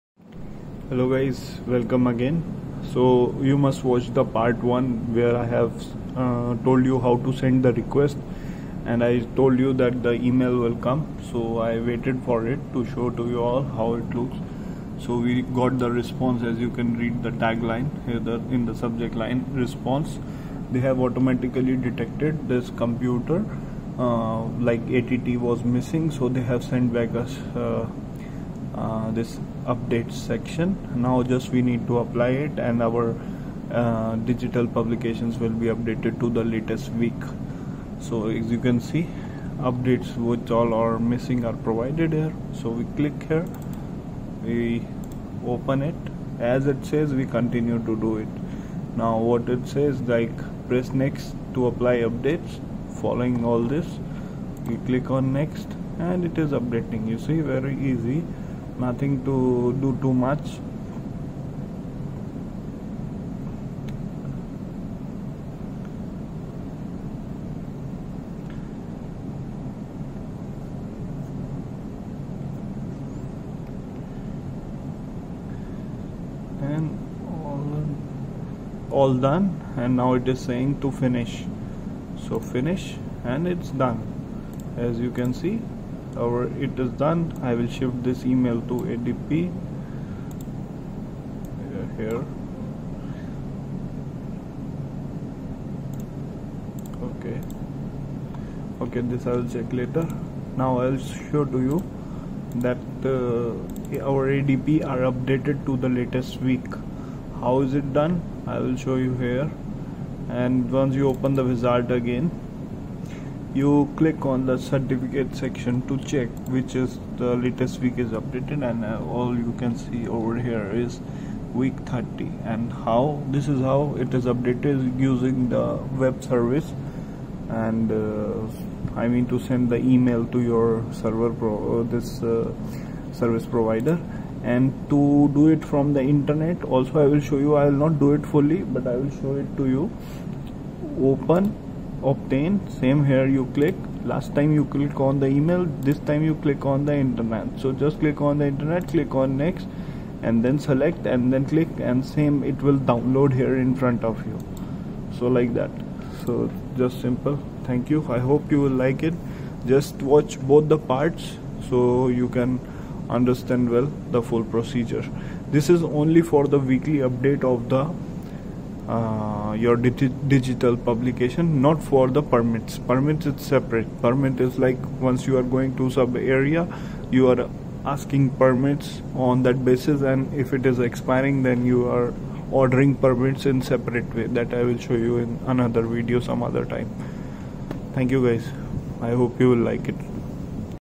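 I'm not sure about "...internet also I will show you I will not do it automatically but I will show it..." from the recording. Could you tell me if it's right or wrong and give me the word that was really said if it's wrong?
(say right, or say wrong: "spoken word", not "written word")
wrong: "fully", not "automatically".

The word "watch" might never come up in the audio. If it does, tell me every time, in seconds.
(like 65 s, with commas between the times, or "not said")
3 s, 160 s.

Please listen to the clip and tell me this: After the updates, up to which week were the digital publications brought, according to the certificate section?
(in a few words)
Week 30.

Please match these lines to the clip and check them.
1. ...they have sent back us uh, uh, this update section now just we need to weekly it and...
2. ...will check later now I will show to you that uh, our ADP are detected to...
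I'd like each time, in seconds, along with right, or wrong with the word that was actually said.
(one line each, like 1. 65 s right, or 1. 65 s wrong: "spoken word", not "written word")
1. 26 s wrong: "apply", not "weekly"
2. 99 s wrong: "updated", not "detected".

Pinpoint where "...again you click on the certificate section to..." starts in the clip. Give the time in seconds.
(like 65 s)
111 s.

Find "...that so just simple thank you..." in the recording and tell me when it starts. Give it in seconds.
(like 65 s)
155 s.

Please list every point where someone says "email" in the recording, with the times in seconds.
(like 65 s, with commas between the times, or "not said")
10 s, 88 s, 129 s, 145 s.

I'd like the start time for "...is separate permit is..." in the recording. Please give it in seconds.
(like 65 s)
173 s.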